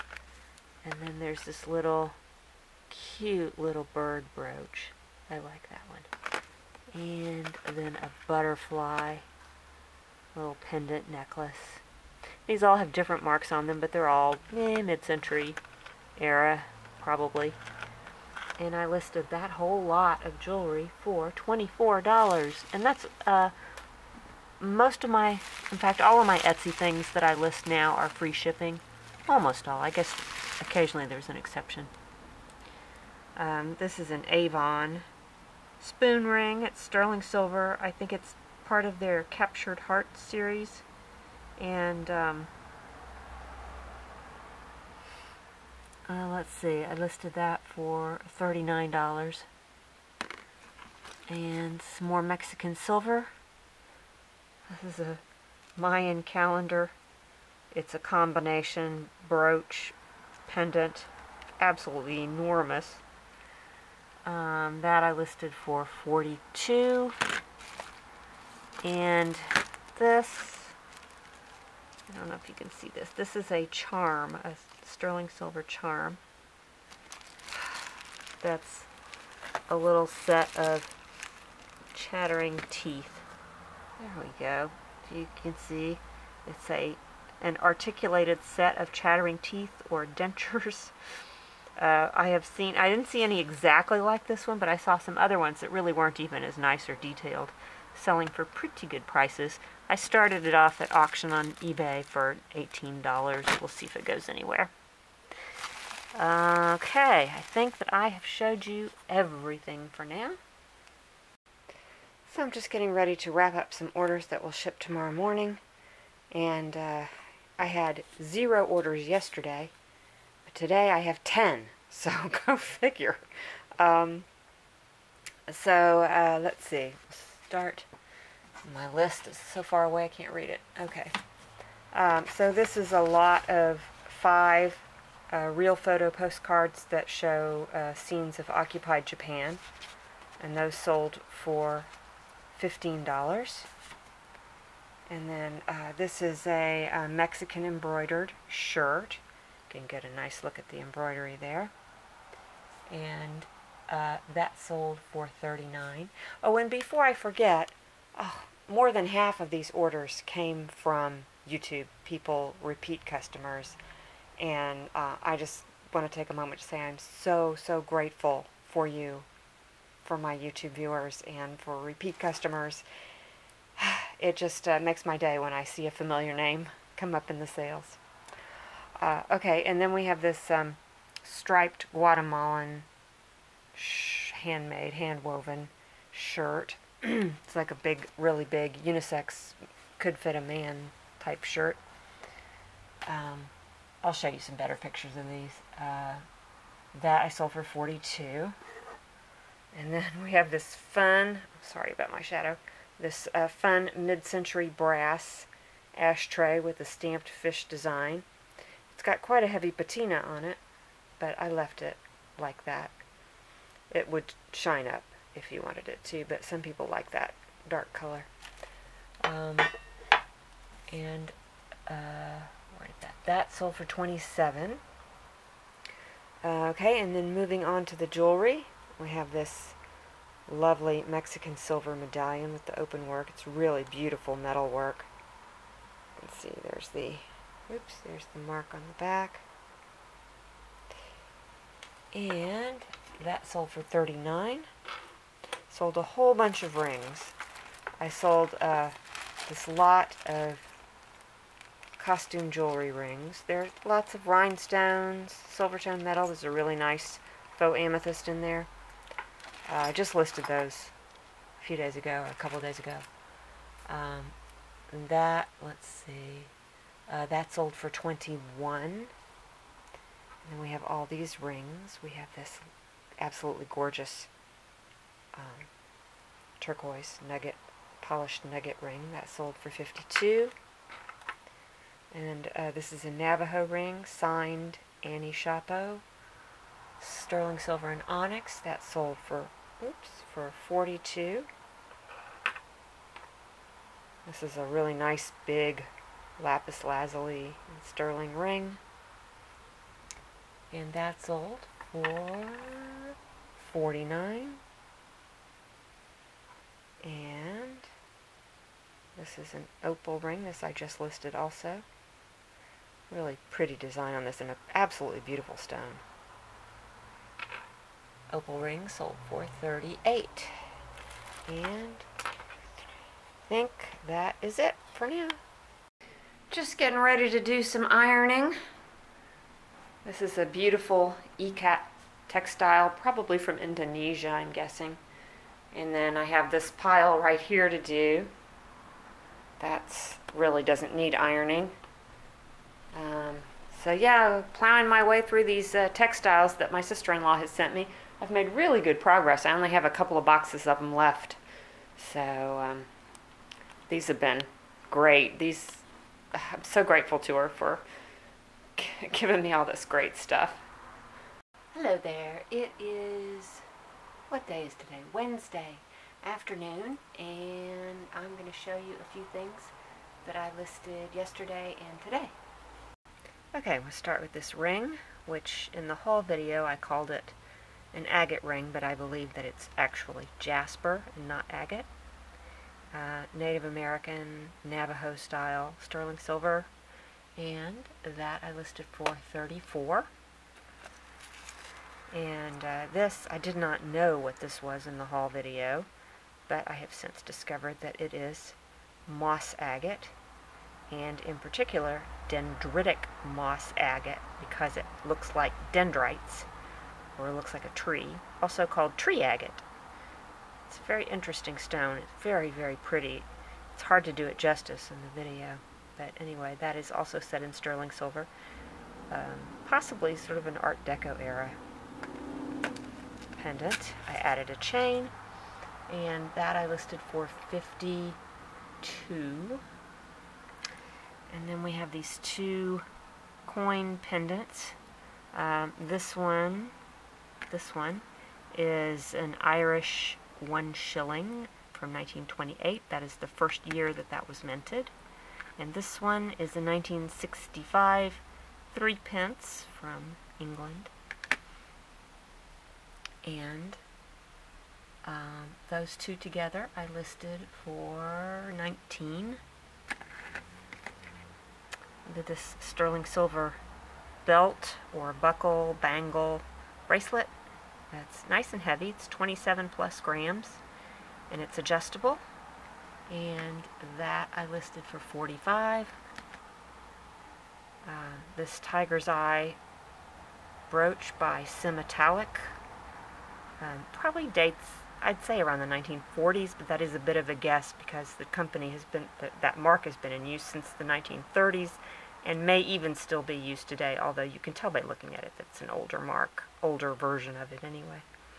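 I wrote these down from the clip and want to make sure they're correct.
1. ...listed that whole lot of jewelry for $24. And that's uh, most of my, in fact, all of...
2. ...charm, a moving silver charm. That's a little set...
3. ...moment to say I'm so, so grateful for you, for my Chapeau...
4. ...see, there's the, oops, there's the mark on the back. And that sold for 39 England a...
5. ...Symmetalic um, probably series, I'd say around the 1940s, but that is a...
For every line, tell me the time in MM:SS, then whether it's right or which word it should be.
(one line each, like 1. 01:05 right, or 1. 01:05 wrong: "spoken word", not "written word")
1. 00:18 right
2. 01:13 wrong: "sterling", not "moving"
3. 02:46 wrong: "YouTube", not "Chapeau"
4. 03:56 wrong: "Sold", not "England"
5. 08:01 wrong: "dates", not "series".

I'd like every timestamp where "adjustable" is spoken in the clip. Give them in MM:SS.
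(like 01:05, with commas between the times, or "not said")
07:51.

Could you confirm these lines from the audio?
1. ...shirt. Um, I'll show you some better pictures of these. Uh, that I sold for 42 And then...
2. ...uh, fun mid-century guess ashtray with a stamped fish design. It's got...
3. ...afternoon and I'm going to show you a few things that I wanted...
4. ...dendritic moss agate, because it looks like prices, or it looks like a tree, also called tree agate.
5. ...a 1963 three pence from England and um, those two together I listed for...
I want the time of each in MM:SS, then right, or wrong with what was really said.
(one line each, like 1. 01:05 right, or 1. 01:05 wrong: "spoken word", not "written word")
1. 03:11 right
2. 03:23 wrong: "brass", not "guess"
3. 06:06 wrong: "listed", not "wanted"
4. 06:42 wrong: "dendrites", not "prices"
5. 07:26 wrong: "1965", not "1963".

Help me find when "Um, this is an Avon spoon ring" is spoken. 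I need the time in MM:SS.
00:33.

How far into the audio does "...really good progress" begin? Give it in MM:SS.
05:48.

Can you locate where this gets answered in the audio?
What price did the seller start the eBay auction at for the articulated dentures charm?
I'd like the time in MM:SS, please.
01:42.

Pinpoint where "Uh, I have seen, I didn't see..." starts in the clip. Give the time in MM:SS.
01:31.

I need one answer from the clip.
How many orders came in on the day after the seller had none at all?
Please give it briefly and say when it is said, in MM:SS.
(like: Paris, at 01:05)
10, at 02:01.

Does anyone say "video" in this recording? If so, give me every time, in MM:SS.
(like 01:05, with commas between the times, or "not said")
06:16, 06:35, 06:55.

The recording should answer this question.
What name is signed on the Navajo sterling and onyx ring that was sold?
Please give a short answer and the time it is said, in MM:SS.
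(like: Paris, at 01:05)
Annie Chapeau, at 04:45.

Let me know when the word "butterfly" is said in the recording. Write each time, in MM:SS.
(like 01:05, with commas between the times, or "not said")
00:08.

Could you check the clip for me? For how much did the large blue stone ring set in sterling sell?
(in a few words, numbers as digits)
$49.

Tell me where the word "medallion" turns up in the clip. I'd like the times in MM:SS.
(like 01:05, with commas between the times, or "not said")
03:51.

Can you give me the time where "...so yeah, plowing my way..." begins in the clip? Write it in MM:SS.
05:43.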